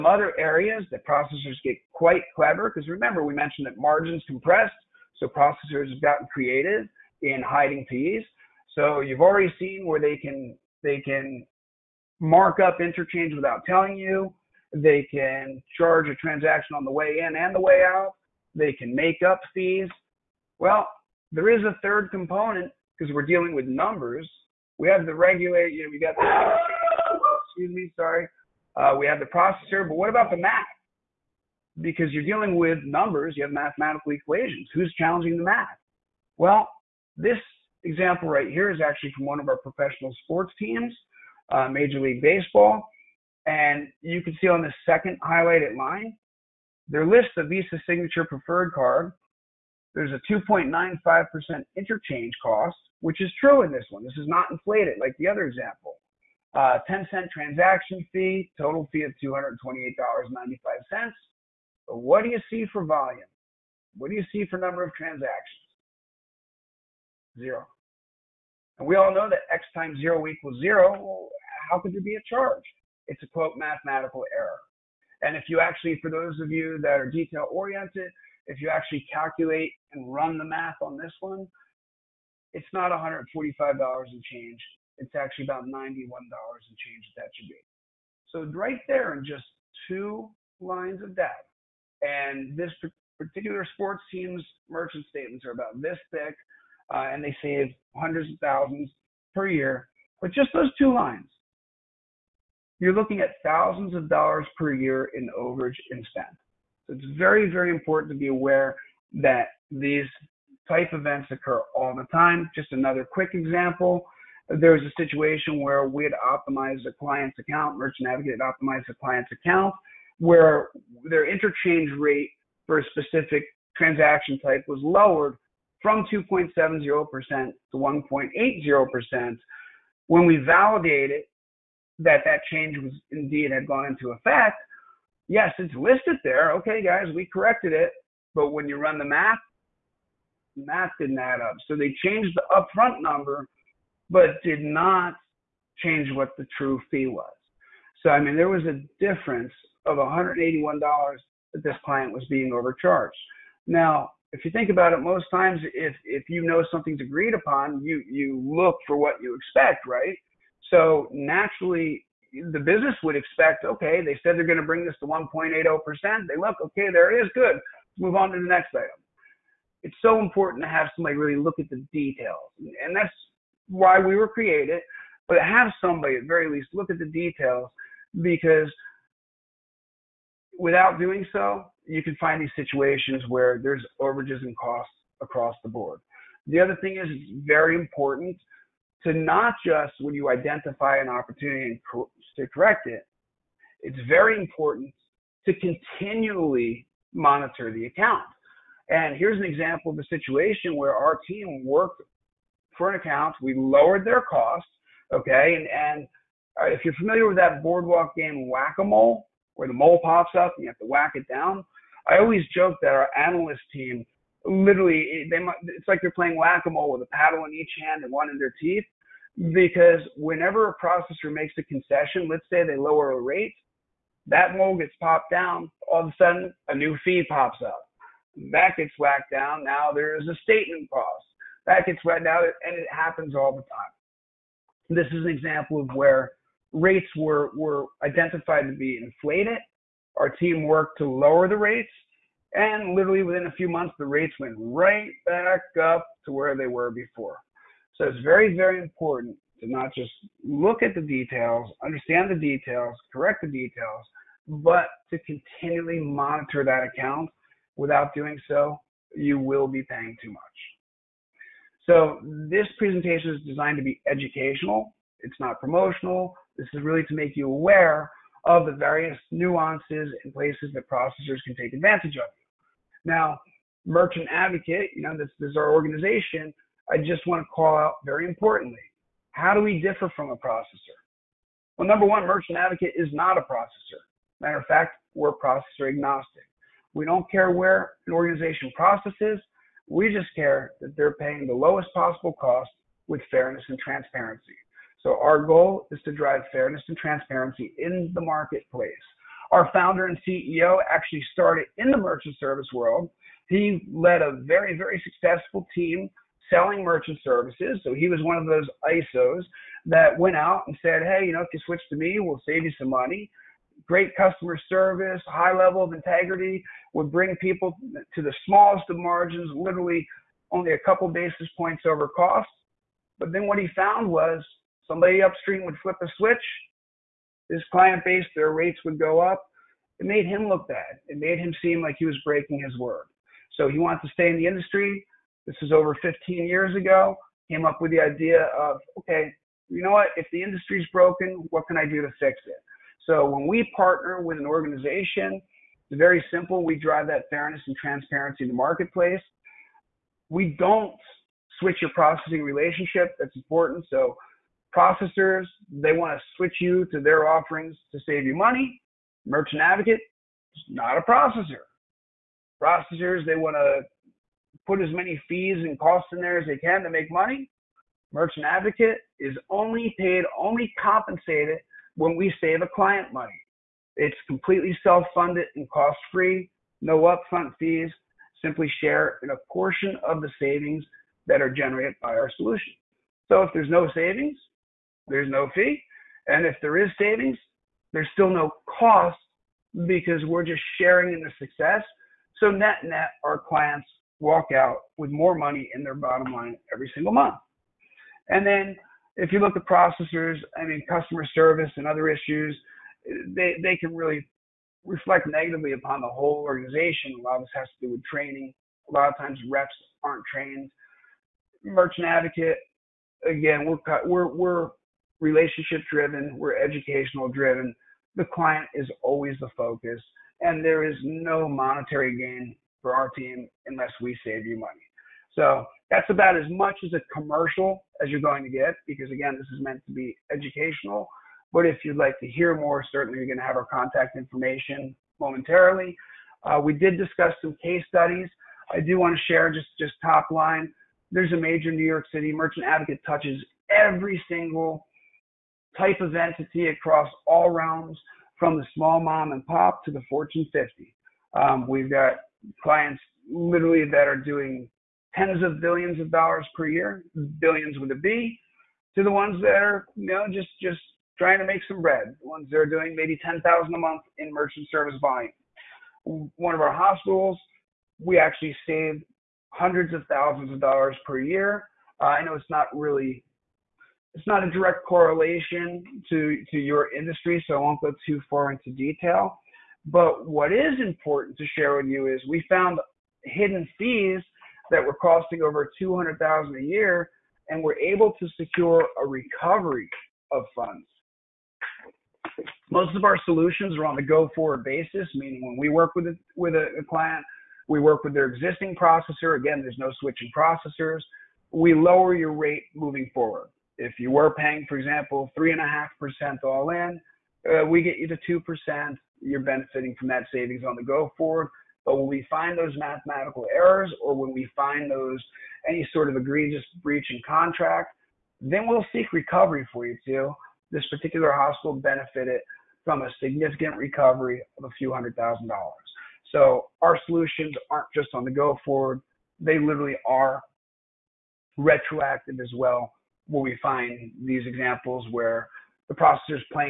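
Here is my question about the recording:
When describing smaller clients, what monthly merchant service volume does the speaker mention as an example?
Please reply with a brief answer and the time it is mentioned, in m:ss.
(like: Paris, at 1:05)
10,000 a month, at 7:43.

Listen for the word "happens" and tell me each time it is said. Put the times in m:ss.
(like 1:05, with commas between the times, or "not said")
3:52.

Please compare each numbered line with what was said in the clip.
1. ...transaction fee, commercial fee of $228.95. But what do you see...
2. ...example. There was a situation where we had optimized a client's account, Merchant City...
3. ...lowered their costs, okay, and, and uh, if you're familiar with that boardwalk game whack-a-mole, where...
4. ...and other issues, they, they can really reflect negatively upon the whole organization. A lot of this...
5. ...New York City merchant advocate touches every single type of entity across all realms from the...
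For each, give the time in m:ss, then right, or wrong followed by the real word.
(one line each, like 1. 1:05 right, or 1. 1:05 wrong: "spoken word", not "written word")
1. 0:57 wrong: "total", not "commercial"
2. 1:53 wrong: "Advocate", not "City"
3. 3:23 right
4. 6:41 right
5. 7:21 right.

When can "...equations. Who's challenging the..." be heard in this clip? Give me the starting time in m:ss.
0:34.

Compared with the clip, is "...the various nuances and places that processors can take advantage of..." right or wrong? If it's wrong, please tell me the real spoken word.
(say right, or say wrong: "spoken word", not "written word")
right.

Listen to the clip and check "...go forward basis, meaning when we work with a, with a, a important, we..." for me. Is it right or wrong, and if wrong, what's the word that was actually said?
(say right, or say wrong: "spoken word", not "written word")
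wrong: "client", not "important".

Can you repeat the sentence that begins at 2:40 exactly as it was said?
So naturally, the business would expect, okay, they said they're going to bring this to 1.80 percent.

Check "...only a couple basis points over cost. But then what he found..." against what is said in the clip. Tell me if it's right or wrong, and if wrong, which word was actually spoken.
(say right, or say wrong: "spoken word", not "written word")
right.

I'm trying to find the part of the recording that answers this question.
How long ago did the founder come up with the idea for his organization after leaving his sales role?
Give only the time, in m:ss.
5:35.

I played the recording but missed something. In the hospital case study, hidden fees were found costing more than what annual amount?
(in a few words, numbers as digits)
over 200,000.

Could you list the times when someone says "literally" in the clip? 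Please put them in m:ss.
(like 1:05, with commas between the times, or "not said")
3:34, 4:02, 5:19, 7:33, 8:49.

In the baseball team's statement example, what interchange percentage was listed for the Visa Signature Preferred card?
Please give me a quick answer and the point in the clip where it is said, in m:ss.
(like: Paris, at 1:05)
2.95%, at 0:50.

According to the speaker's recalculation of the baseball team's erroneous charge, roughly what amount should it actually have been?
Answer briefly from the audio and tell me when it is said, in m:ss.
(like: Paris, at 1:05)
about $91, at 1:25.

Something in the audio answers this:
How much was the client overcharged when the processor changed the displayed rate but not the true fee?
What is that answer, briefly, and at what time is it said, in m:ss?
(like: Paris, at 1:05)
$181, at 2:29.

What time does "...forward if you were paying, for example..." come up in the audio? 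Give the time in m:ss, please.
8:23.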